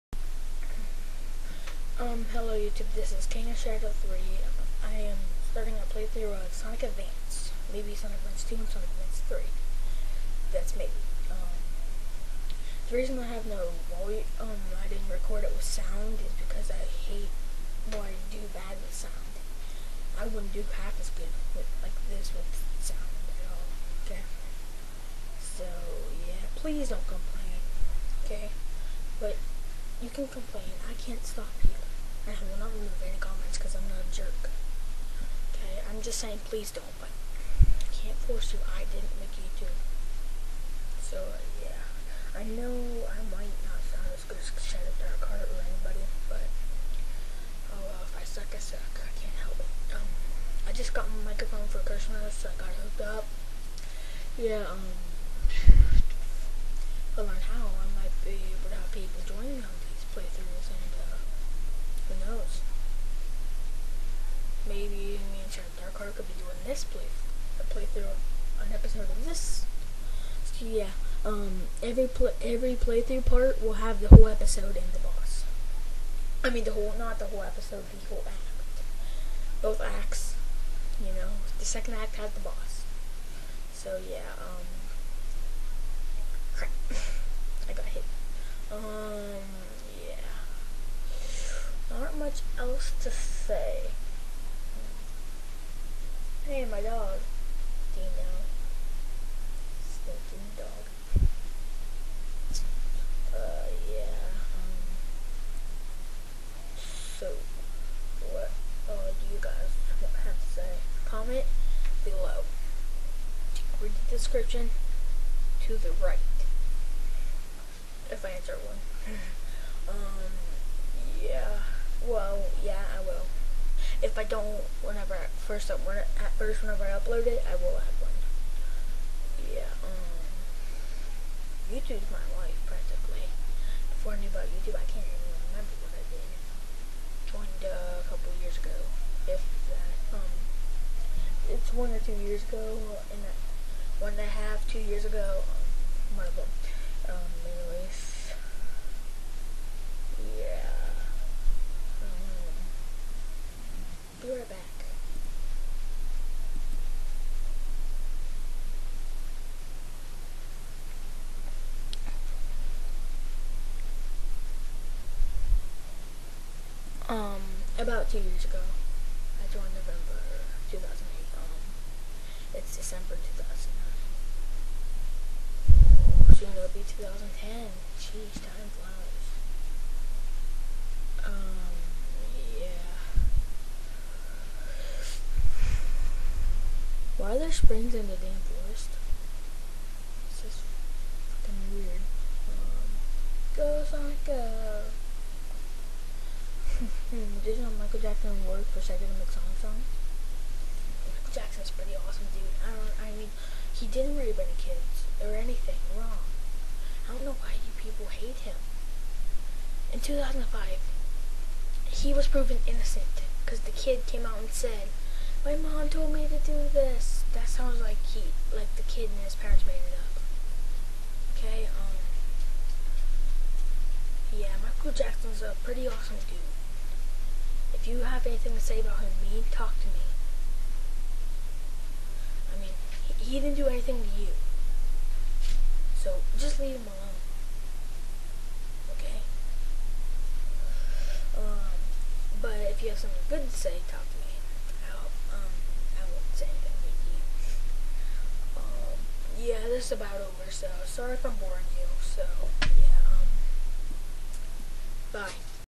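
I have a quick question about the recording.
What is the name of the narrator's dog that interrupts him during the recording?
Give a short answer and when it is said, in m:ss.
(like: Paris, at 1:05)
Dino, at 1:37.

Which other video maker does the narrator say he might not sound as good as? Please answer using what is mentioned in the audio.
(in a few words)
Shadow Dark Heart.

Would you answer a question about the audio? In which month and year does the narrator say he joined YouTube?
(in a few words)
November 2008.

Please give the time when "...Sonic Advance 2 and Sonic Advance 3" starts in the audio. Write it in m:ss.
0:07.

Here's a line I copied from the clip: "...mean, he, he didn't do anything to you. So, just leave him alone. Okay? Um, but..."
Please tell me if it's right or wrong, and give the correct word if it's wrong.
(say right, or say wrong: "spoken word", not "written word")
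right.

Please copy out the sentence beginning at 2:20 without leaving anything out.
Um, it's one or two years ago, and uh, one and a half, two years ago.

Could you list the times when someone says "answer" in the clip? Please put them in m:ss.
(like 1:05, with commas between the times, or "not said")
1:58.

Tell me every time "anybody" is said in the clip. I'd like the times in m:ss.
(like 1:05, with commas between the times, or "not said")
0:45.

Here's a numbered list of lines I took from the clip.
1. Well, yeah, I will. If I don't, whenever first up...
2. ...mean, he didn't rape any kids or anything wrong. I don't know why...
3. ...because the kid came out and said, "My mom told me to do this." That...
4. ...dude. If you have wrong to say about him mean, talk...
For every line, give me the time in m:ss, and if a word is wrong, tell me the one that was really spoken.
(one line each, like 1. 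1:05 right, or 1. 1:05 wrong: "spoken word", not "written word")
1. 2:02 right
2. 3:23 right
3. 3:33 right
4. 3:46 wrong: "anything", not "wrong".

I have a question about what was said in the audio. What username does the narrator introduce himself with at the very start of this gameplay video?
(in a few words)
King of Shadow 3.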